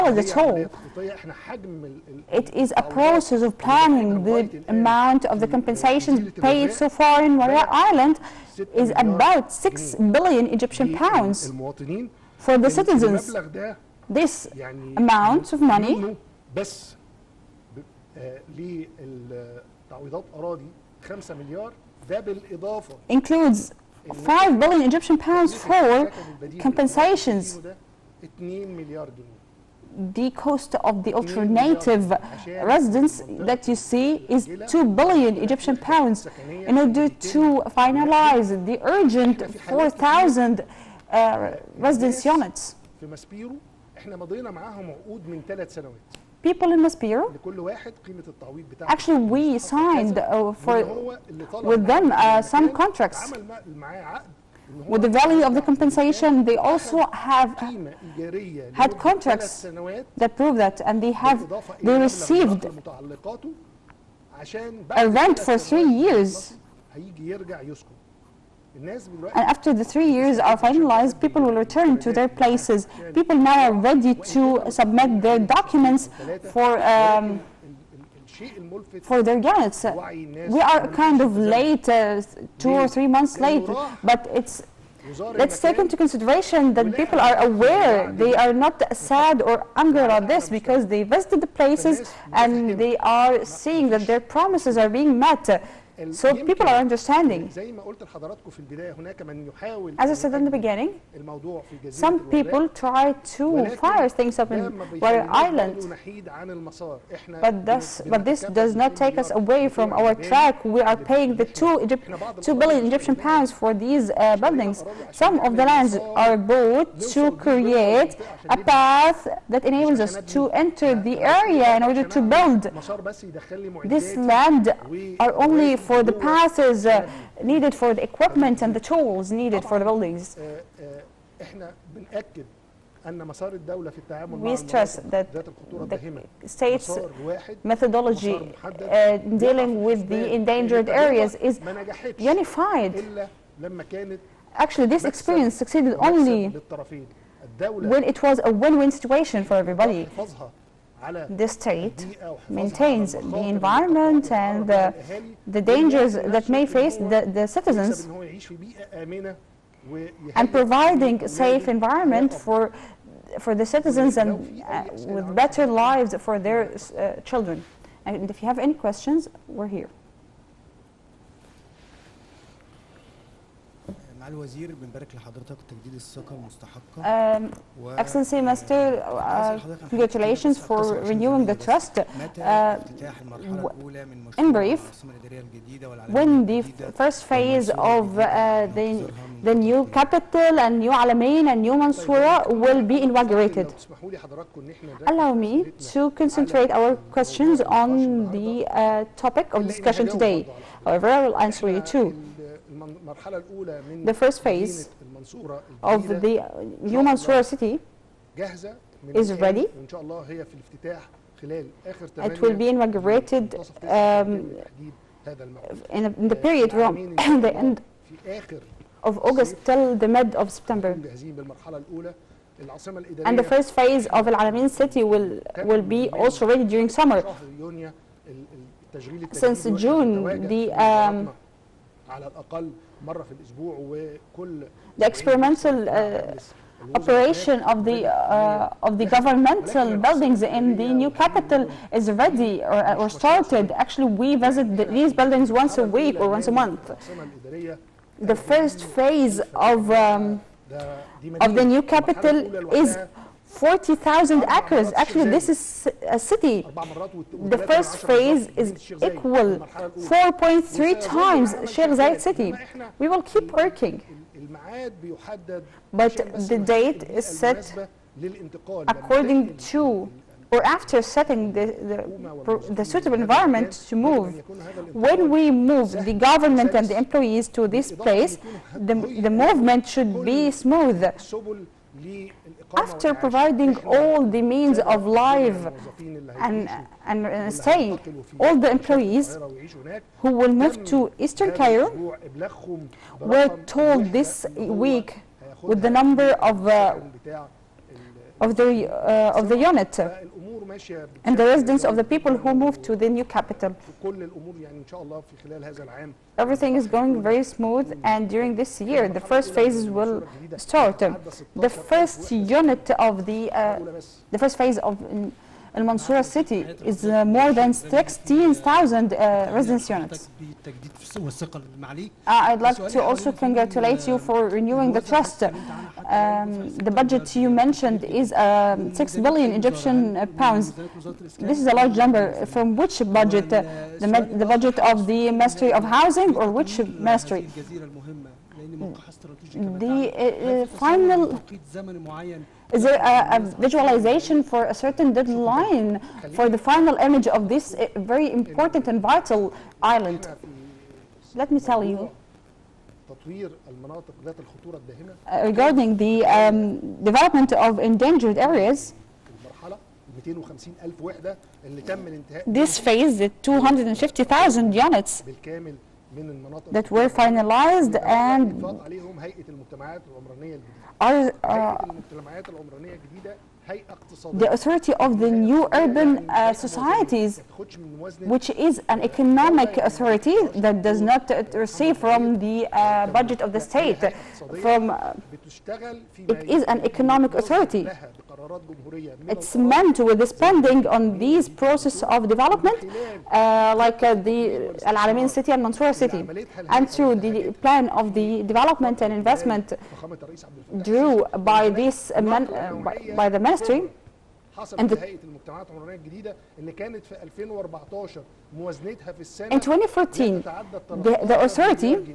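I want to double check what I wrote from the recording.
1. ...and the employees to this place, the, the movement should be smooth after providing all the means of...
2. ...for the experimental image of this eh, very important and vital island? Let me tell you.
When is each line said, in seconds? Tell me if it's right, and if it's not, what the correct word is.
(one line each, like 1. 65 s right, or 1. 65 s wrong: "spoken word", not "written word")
1. 276 s right
2. 346 s wrong: "final", not "experimental".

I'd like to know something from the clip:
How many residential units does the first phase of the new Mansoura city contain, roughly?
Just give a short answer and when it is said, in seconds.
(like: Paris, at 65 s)
more than 16,000, at 317 s.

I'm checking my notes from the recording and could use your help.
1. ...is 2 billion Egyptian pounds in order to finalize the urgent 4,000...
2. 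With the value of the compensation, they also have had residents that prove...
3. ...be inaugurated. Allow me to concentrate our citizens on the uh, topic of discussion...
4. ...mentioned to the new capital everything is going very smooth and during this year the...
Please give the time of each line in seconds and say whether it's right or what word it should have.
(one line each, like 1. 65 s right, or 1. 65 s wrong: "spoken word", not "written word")
1. 34 s right
2. 54 s wrong: "contracts", not "residents"
3. 192 s wrong: "questions", not "citizens"
4. 302 s wrong: "moved", not "mentioned".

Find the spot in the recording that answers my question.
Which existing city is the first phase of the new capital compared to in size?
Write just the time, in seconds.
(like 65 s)
261 s.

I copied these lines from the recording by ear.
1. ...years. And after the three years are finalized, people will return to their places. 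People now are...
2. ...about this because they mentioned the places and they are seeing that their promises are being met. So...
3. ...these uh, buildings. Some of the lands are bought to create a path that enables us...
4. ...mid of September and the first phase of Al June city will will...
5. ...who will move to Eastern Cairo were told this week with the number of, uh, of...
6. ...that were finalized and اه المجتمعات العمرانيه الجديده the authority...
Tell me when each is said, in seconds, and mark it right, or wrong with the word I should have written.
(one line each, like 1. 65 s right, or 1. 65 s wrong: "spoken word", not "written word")
1. 66 s right
2. 89 s wrong: "visited", not "mentioned"
3. 113 s right
4. 220 s wrong: "Alamein", not "June"
5. 290 s right
6. 366 s right.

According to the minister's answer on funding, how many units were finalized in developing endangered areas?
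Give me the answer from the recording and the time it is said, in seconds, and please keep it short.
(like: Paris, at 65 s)
250,000, at 363 s.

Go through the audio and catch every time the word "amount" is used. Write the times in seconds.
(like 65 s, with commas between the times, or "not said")
4 s, 14 s.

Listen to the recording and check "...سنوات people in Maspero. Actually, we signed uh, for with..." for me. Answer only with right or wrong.
right.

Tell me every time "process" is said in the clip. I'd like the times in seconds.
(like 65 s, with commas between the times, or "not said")
2 s, 391 s.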